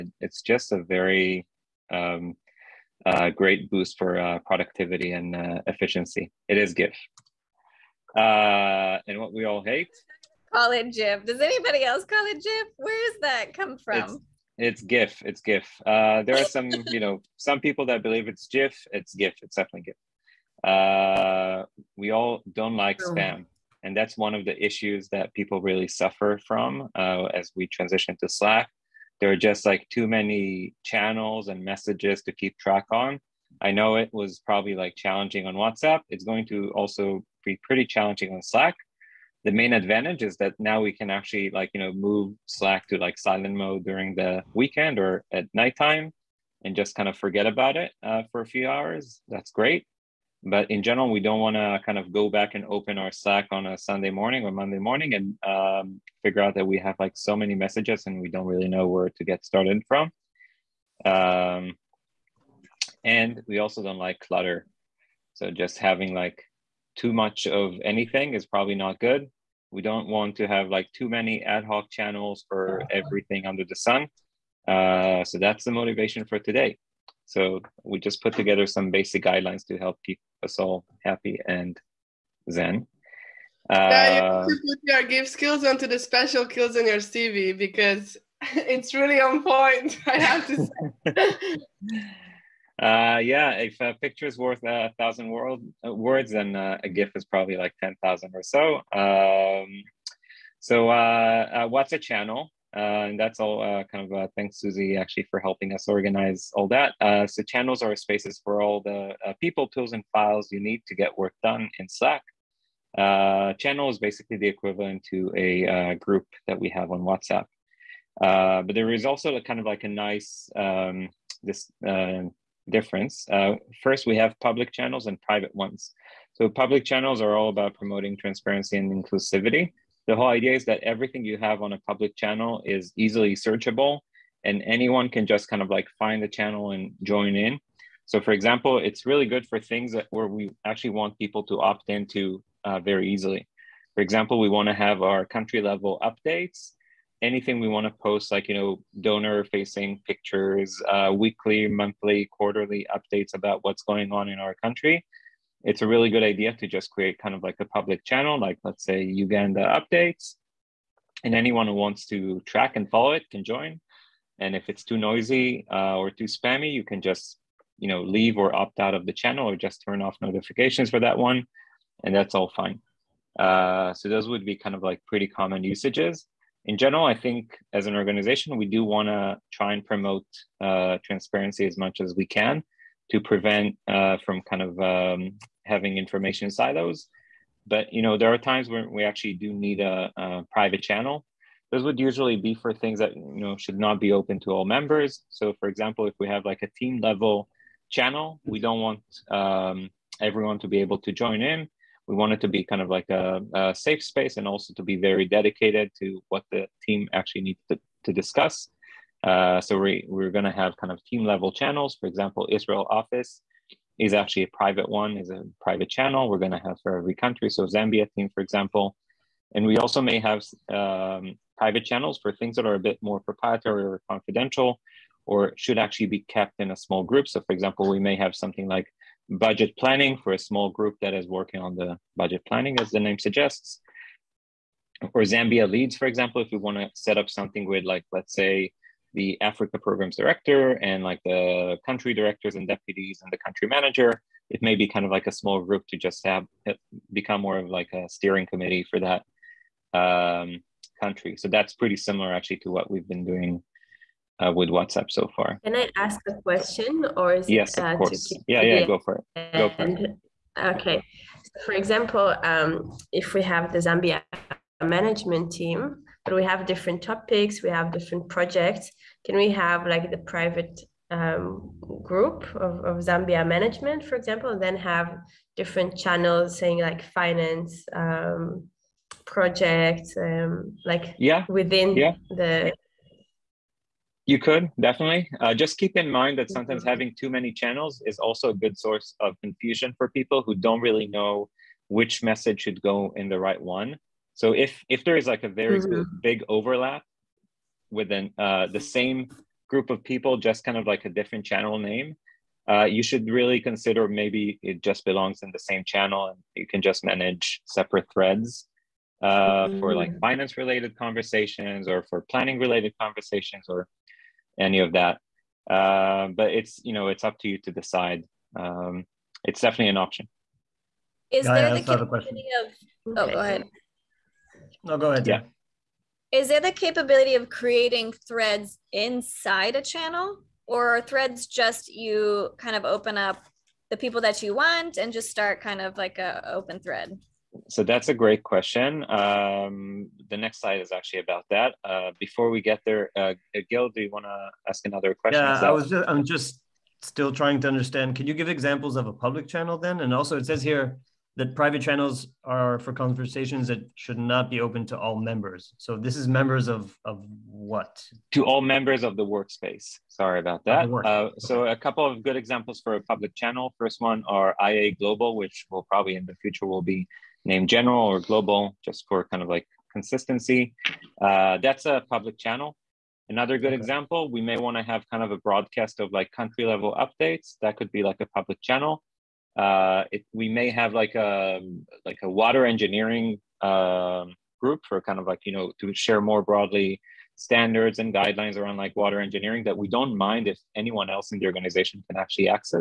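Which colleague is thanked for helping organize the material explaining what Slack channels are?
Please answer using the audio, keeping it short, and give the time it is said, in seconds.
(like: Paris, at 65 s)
Susie, at 104 s.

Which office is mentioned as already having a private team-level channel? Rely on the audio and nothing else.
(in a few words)
Israel office.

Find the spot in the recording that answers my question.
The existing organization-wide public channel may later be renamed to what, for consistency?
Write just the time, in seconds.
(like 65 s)
367 s.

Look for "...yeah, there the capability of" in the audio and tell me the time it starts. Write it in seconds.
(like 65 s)
321 s.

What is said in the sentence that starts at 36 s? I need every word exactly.
It's going to also be pretty challenging on Slack.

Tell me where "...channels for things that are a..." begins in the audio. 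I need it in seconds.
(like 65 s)
221 s.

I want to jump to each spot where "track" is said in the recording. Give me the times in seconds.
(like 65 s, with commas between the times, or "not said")
32 s, 162 s.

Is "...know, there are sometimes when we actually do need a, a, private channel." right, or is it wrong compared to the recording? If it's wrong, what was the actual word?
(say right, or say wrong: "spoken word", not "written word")
wrong: "times", not "sometimes".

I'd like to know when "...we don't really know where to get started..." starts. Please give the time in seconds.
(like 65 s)
58 s.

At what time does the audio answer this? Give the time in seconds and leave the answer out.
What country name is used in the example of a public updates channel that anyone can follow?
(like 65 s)
159 s.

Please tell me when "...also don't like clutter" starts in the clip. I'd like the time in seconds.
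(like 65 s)
63 s.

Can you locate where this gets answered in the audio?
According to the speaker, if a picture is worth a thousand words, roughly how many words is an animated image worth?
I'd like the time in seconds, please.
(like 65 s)
97 s.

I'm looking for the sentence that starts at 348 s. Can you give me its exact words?
Can you give examples of a public channel then?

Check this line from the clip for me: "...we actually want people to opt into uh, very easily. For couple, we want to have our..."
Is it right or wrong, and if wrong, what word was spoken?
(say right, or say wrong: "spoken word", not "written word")
wrong: "example", not "couple".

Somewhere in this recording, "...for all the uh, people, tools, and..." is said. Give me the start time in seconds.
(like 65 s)
108 s.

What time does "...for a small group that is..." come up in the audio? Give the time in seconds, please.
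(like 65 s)
230 s.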